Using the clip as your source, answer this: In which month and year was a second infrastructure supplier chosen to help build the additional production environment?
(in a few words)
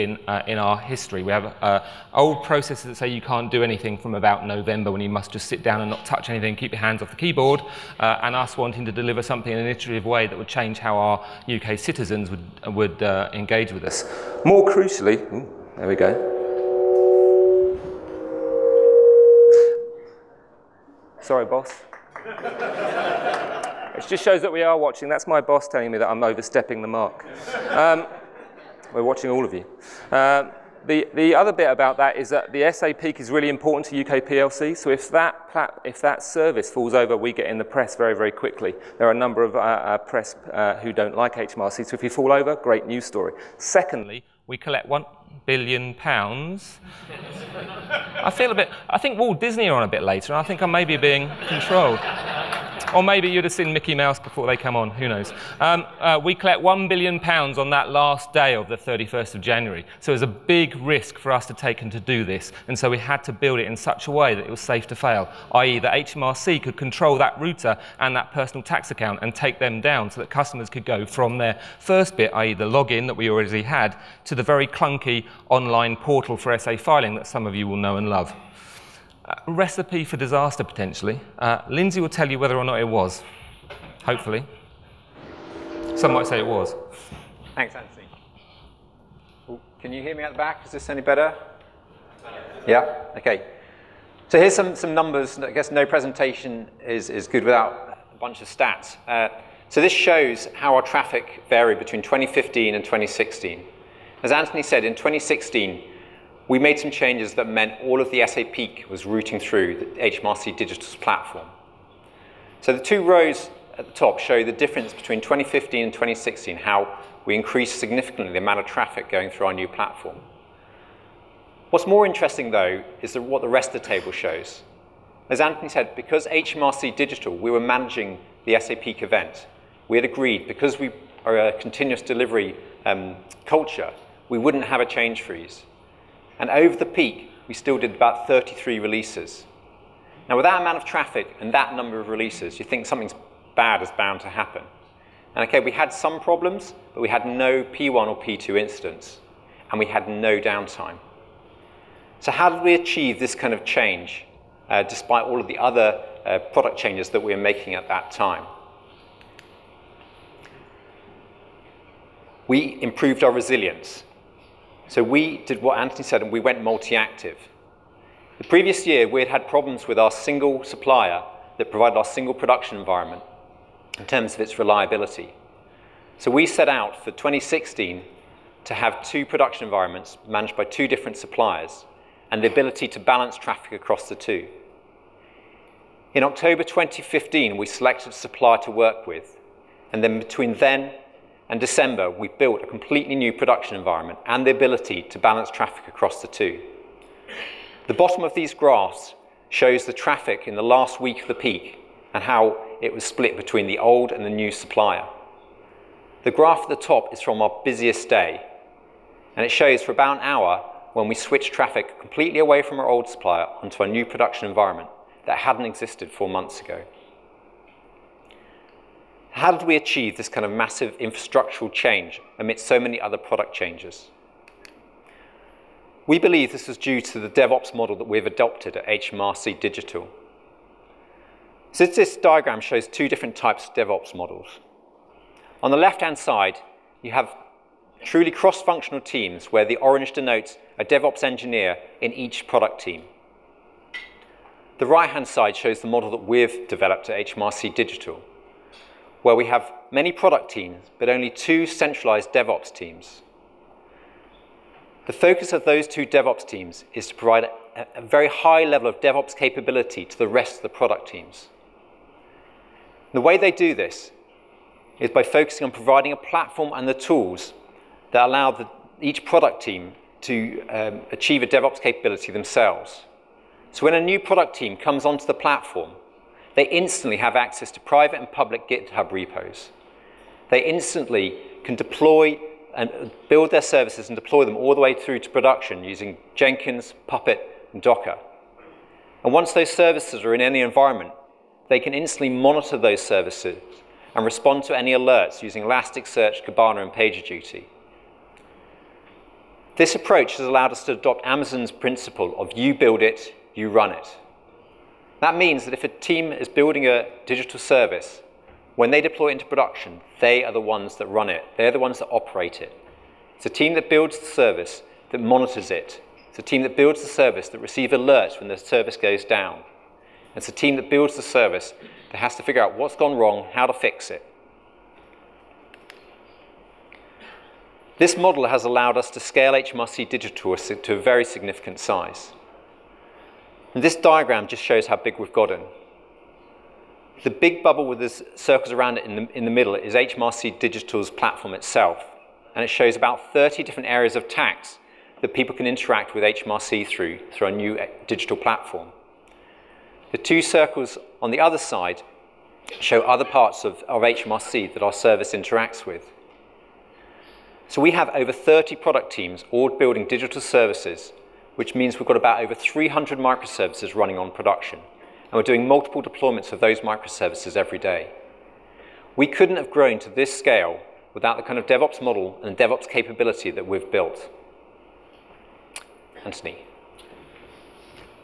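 October 2015.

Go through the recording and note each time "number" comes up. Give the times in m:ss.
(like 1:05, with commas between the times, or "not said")
0:39, 1:34, 2:21.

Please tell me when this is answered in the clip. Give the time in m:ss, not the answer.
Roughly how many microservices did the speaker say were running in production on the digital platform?
6:02.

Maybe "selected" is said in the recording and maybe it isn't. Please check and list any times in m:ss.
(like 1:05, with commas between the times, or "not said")
3:07.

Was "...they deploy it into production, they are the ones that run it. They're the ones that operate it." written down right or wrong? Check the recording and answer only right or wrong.
right.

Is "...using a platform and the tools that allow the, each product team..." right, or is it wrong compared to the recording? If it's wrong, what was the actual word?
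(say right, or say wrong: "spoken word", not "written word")
wrong: "providing", not "using".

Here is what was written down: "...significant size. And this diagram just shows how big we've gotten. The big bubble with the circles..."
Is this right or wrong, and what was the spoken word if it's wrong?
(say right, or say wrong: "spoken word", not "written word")
right.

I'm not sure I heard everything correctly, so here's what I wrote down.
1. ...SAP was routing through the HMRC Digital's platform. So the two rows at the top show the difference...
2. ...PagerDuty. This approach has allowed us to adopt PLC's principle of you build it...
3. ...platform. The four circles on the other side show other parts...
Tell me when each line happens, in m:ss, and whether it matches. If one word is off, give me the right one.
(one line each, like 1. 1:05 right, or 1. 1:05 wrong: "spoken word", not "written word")
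1. 1:48 right
2. 4:56 wrong: "Amazon", not "PLC"
3. 5:48 wrong: "two", not "four".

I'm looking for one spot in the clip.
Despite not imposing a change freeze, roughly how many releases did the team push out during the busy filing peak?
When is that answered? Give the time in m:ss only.
2:18.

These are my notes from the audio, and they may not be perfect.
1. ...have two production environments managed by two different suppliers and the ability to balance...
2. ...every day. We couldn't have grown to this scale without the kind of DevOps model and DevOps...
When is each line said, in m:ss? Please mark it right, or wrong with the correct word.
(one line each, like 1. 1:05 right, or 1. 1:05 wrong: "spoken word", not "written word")
1. 2:58 right
2. 6:07 right.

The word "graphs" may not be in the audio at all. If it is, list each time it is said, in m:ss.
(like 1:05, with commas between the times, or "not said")
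3:18, 3:26.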